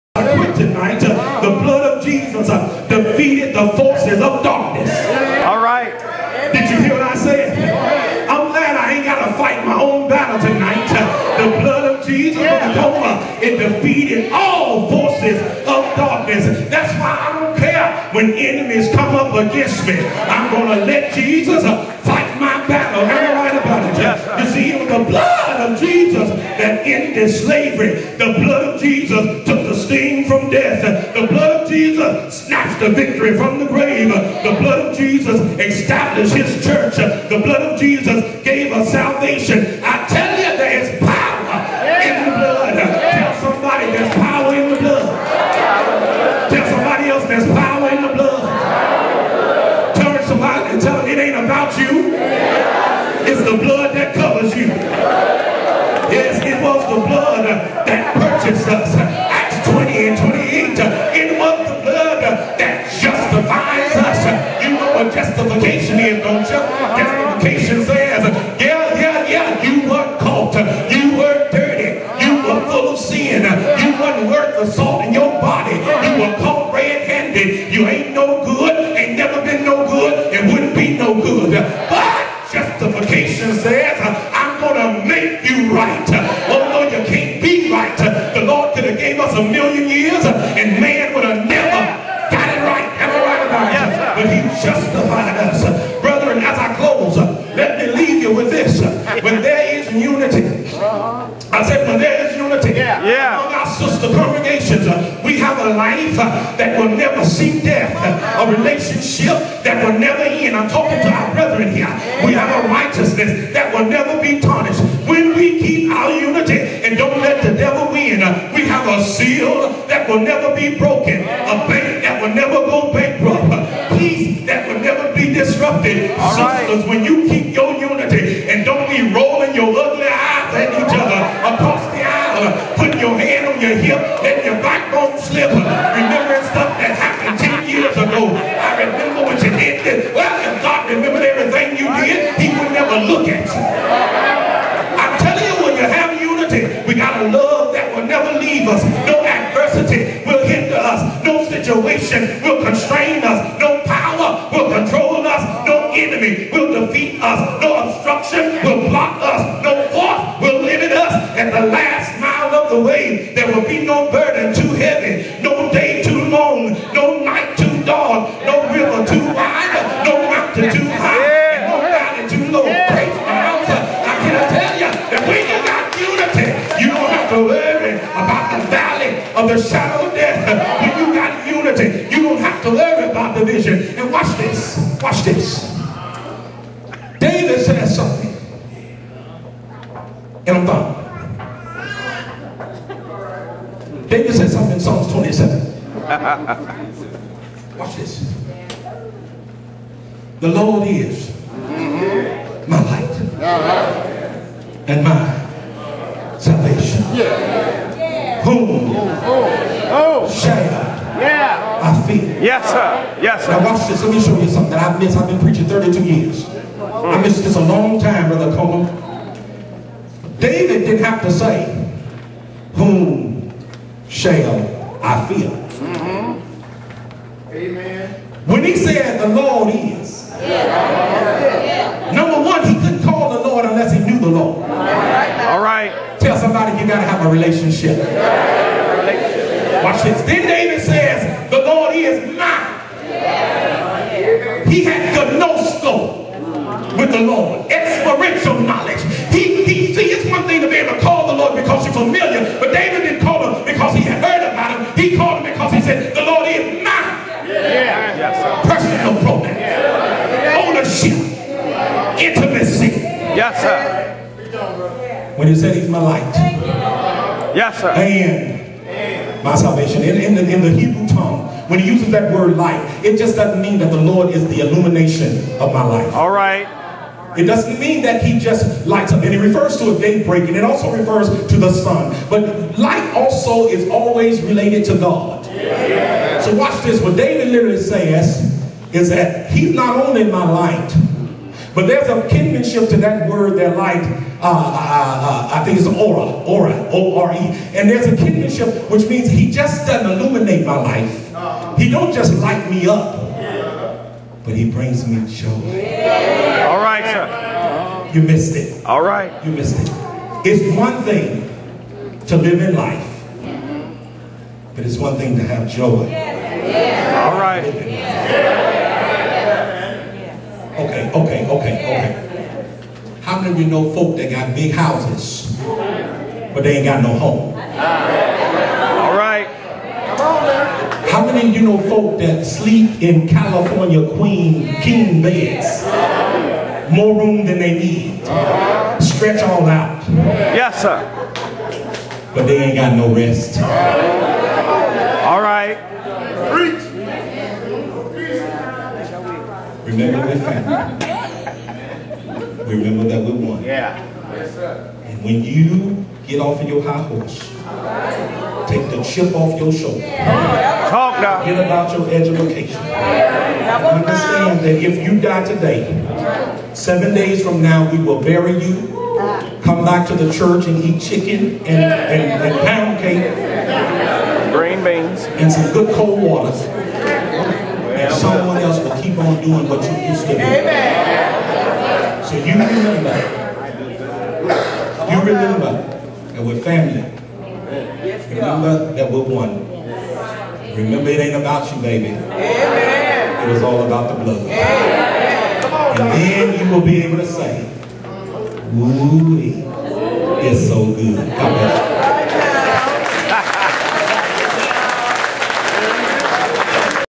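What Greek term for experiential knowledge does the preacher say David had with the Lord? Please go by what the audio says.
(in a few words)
gnosko.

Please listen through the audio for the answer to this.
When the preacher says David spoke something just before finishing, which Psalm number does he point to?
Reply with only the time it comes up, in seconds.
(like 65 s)
194 s.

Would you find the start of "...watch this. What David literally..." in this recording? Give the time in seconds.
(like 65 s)
286 s.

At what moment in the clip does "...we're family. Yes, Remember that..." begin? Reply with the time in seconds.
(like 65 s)
386 s.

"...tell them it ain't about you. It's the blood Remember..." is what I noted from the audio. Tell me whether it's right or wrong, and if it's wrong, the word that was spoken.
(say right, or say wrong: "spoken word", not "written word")
wrong: "Acts", not "Remember".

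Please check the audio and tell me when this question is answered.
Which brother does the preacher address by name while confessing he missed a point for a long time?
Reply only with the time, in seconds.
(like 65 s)
218 s.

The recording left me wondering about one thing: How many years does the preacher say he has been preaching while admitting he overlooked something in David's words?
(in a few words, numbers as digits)
32.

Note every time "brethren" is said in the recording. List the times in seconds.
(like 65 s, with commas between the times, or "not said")
95 s, 111 s.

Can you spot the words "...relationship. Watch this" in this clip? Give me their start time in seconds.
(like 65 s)
237 s.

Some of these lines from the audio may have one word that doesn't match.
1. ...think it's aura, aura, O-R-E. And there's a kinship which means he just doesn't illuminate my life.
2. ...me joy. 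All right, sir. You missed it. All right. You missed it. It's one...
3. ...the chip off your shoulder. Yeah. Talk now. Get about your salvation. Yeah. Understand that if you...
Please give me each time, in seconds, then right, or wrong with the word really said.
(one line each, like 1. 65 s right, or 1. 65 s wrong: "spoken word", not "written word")
1. 295 s right
2. 305 s right
3. 358 s wrong: "education", not "salvation".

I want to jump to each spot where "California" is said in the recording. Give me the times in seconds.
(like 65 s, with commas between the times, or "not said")
333 s.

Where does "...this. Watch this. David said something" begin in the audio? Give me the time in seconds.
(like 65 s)
184 s.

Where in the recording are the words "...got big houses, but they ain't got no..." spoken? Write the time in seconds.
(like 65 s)
324 s.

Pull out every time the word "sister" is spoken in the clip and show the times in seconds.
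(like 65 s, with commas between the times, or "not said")
103 s, 126 s.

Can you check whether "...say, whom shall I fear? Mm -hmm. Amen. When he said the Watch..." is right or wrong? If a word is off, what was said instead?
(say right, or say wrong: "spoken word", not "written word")
wrong: "Lord", not "Watch".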